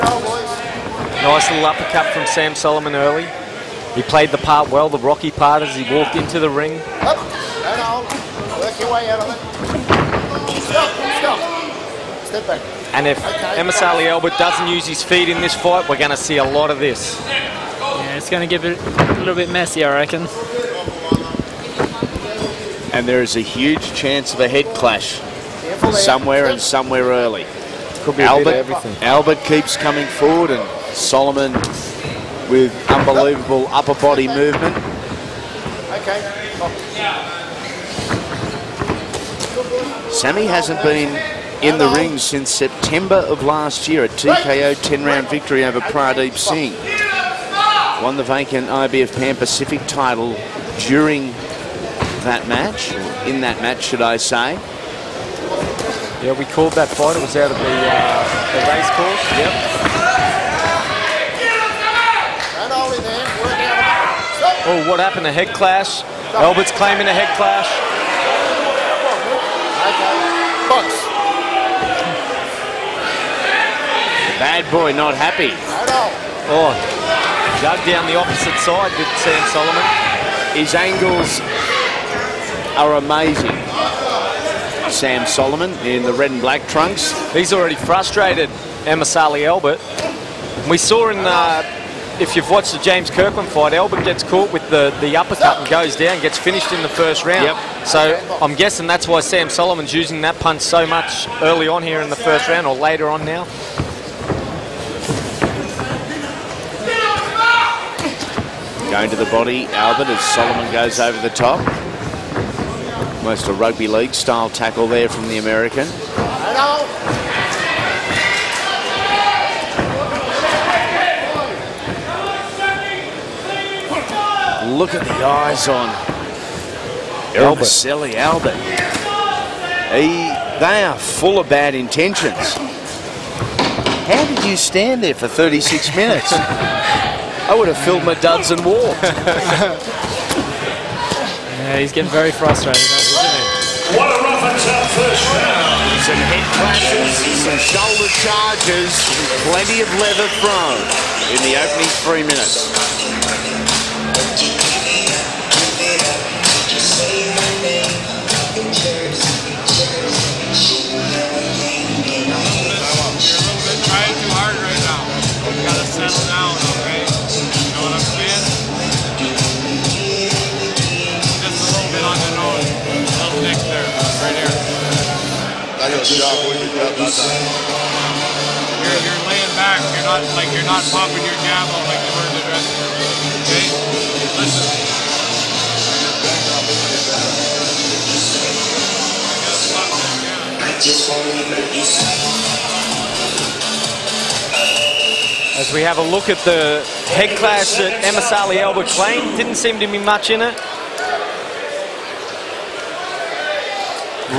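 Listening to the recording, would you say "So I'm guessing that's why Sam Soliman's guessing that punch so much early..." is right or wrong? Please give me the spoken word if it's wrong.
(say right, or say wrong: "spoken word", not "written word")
wrong: "using", not "guessing".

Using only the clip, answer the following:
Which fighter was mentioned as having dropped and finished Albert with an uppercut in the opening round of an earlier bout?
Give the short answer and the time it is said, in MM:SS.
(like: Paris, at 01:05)
James Kirkland, at 01:32.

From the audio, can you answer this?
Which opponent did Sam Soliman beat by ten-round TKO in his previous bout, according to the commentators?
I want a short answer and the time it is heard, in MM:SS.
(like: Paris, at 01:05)
Pradeep Singh, at 00:45.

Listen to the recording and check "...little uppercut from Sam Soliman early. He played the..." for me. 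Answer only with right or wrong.
right.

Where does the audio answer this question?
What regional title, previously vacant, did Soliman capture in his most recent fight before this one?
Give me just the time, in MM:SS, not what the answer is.
00:48.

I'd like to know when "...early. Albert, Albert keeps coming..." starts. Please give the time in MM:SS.
00:27.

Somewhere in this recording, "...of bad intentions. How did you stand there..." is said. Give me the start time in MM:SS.
02:11.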